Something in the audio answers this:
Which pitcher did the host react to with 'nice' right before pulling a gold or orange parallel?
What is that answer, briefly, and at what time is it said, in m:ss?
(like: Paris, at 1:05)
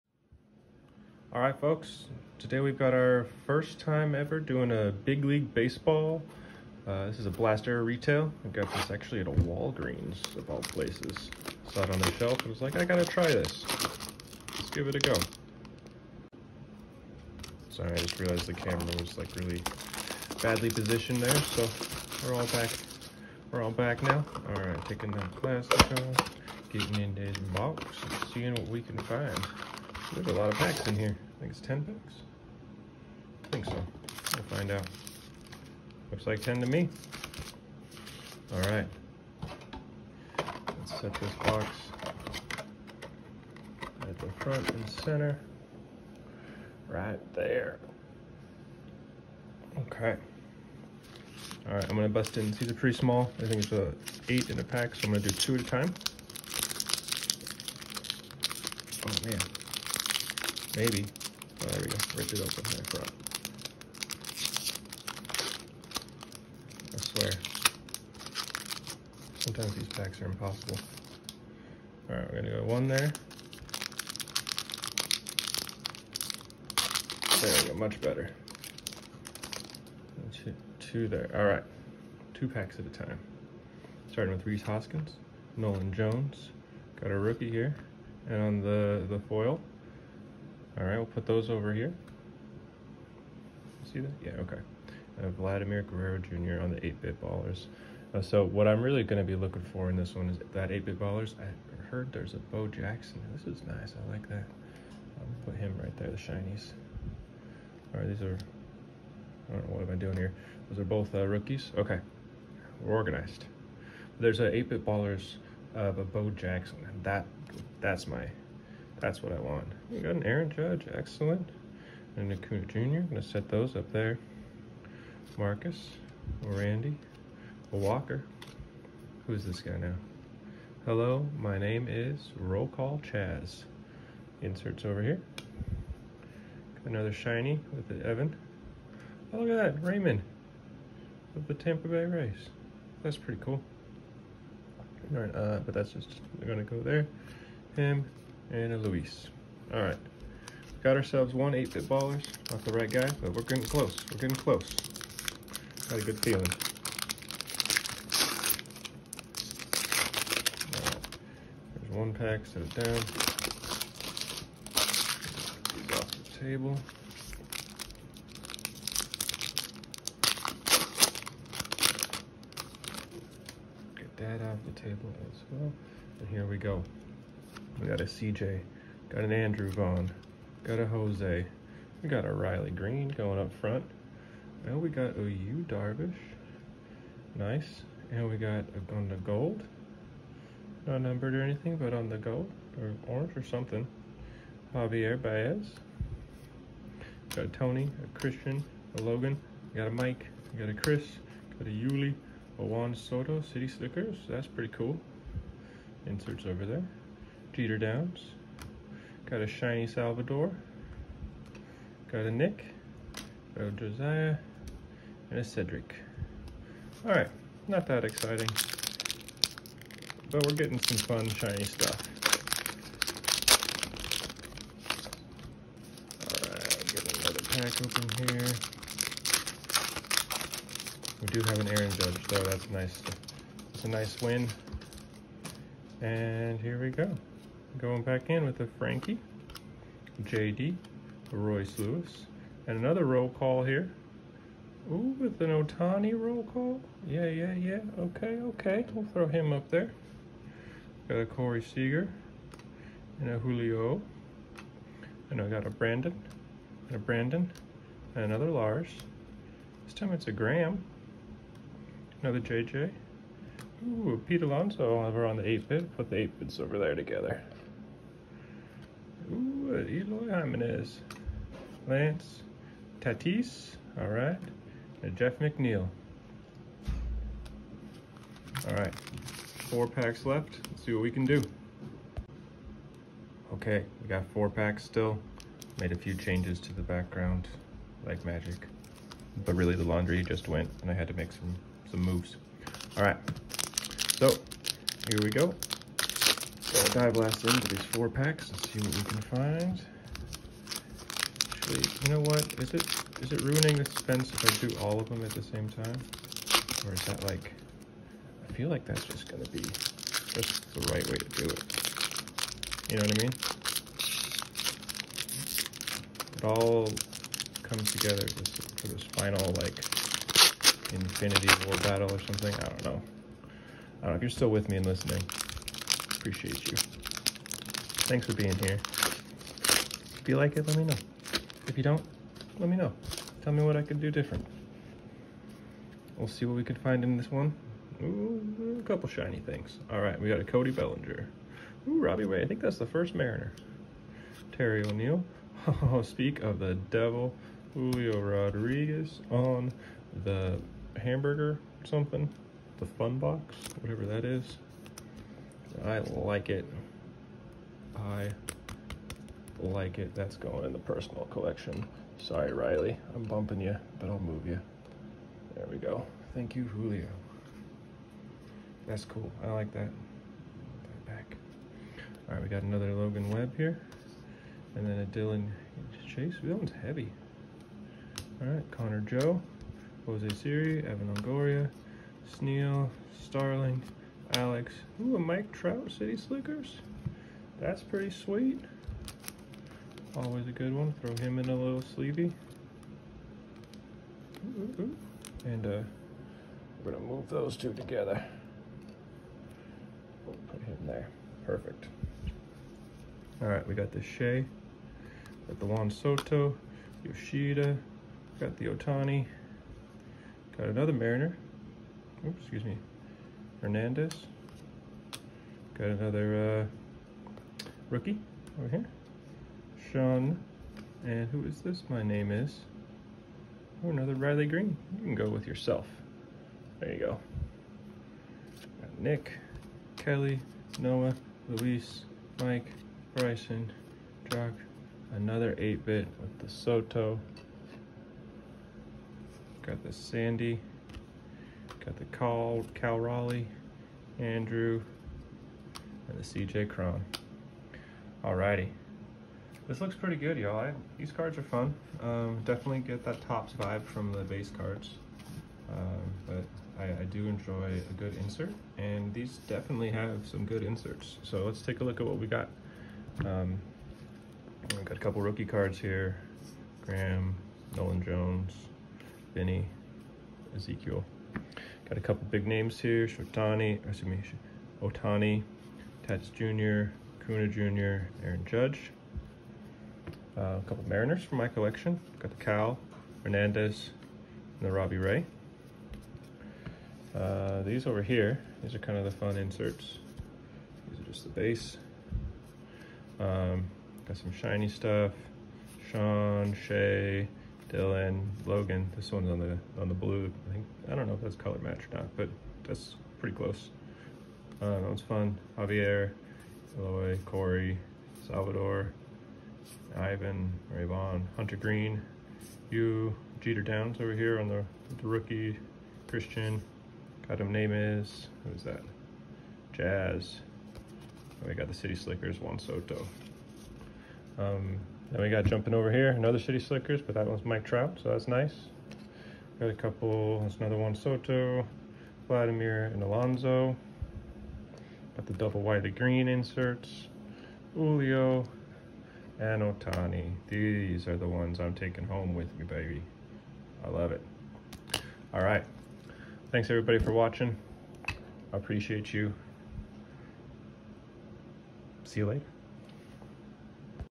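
Yu Darvish, at 3:05.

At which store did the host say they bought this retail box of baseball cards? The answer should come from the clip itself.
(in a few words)
Walgreens.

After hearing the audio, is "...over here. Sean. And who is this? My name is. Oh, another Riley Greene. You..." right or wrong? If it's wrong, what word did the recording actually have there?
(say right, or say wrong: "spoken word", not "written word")
right.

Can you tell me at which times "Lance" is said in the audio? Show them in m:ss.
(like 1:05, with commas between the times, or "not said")
4:31.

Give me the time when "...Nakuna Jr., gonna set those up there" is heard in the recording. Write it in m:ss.
2:02.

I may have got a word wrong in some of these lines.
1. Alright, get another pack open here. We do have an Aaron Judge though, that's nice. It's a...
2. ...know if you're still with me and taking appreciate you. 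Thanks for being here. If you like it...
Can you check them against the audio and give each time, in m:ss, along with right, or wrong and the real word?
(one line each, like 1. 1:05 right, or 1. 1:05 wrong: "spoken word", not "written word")
1. 3:46 right
2. 5:24 wrong: "listening", not "taking".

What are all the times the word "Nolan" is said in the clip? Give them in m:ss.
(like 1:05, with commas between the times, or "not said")
1:25, 7:47.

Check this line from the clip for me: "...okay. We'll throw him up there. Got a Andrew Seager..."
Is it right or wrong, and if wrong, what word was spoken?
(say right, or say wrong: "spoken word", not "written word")
wrong: "Corey", not "Andrew".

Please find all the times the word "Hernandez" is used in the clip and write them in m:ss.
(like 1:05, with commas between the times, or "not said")
6:53, 8:03.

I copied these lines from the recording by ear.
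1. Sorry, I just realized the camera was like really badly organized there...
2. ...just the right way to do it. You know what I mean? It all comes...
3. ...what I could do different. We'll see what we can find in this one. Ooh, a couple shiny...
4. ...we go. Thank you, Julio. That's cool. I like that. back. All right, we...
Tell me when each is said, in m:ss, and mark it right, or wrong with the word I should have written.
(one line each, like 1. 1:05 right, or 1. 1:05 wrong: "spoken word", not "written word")
1. 0:17 wrong: "positioned", not "organized"
2. 5:09 right
3. 5:33 right
4. 6:05 right.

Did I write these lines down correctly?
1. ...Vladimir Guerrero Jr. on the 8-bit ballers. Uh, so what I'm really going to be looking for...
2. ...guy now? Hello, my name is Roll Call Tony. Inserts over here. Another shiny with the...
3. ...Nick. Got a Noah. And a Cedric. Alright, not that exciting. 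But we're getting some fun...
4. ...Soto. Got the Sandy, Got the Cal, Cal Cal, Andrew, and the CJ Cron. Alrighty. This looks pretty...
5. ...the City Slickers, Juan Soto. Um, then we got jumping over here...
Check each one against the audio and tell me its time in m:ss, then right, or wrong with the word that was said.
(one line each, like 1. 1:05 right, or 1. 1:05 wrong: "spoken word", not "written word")
1. 1:35 right
2. 2:09 wrong: "Chaz", not "Tony"
3. 3:32 wrong: "Josiah", not "Noah"
4. 7:16 wrong: "Raleigh", not "Cal"
5. 8:41 right.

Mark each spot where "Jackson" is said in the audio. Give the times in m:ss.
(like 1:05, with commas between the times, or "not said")
1:42, 1:56.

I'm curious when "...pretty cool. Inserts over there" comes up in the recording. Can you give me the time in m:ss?
3:24.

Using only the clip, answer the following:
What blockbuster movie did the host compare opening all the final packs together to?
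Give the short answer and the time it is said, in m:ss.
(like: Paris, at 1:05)
Infinity War, at 5:20.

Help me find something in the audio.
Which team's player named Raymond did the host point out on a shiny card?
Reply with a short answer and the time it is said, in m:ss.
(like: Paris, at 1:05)
Tampa Bay Rays, at 2:21.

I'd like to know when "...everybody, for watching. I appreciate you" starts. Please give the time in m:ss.
9:06.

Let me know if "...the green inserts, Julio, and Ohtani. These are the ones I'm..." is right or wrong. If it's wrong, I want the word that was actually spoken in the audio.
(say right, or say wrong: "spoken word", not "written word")
right.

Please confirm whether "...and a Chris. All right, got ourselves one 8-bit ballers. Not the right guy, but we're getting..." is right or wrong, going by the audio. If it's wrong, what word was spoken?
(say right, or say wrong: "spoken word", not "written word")
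wrong: "Luis", not "Chris".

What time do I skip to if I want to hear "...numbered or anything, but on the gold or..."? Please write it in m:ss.
3:11.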